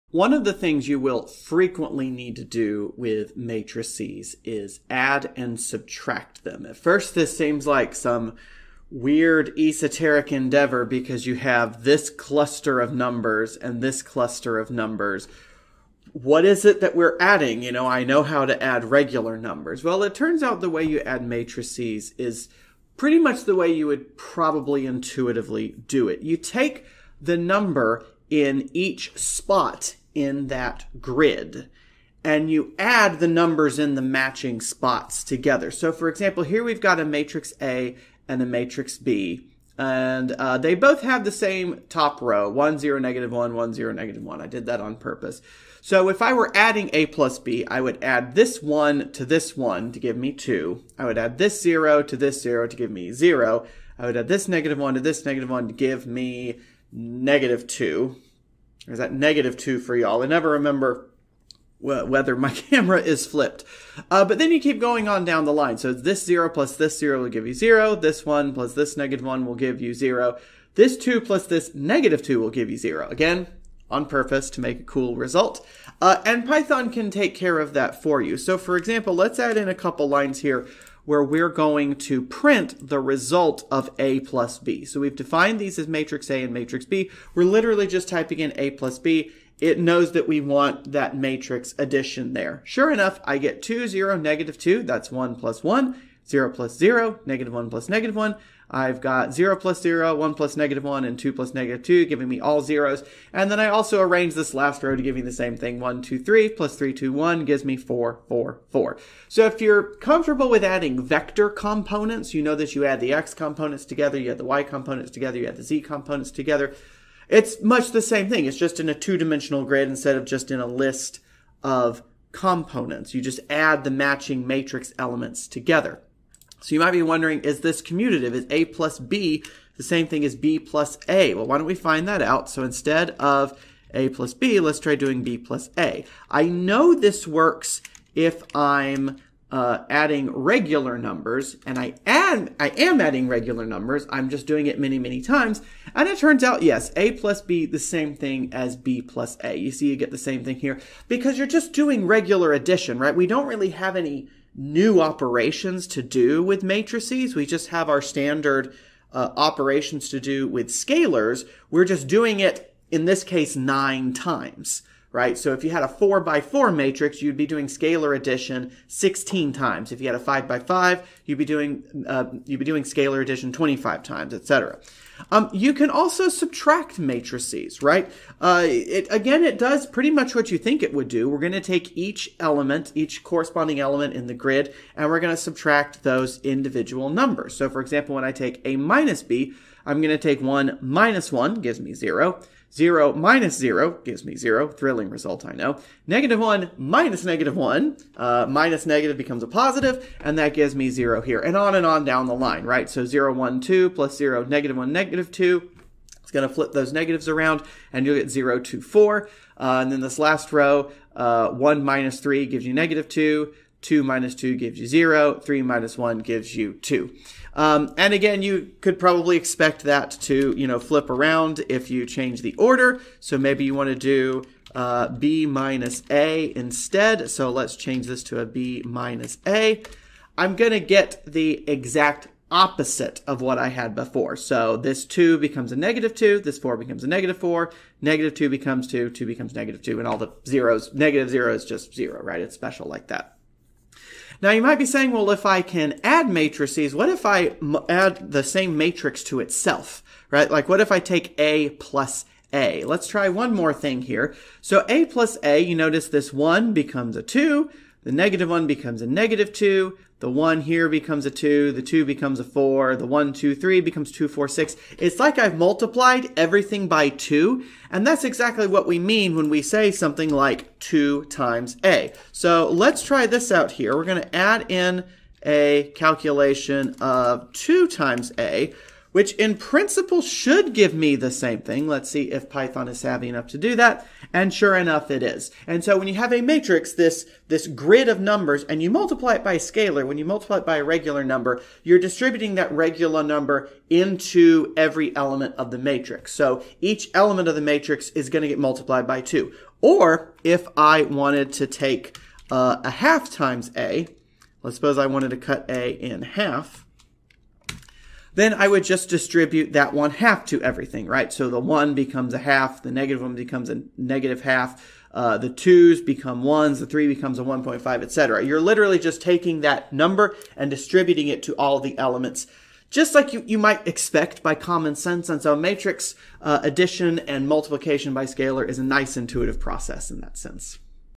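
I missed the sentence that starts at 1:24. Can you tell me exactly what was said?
So we've defined these as matrix A and matrix B.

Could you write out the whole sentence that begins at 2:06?
So you might be wondering, is this commutative?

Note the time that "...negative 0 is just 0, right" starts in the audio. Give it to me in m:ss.
4:00.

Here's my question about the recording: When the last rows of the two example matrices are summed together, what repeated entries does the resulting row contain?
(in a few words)
4, 4, 4.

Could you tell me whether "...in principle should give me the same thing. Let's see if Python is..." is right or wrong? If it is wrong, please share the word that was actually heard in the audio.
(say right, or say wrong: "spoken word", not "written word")
right.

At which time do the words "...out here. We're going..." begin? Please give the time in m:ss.
4:33.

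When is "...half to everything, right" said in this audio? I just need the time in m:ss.
5:10.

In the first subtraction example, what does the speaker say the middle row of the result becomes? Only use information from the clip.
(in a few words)
0, 2, 4.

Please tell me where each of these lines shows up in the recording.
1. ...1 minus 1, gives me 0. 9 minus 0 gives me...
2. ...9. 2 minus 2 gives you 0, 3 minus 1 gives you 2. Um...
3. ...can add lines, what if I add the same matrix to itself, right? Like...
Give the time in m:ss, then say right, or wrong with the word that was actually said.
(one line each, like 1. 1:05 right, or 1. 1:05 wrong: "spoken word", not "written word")
1. 3:10 wrong: "0", not "9"
2. 3:33 wrong: "2", not "9"
3. 4:05 wrong: "matrices", not "lines".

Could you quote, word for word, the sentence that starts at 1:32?
Sure enough, I get 2, 0, negative 2.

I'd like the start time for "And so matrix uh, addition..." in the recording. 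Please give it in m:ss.
5:25.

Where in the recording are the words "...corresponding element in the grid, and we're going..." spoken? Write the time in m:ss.
3:03.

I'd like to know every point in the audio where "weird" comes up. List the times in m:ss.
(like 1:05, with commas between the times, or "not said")
0:08.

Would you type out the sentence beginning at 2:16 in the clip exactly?
I know this works if I'm uh, adding regular numbers, and I am, I am adding regular numbers.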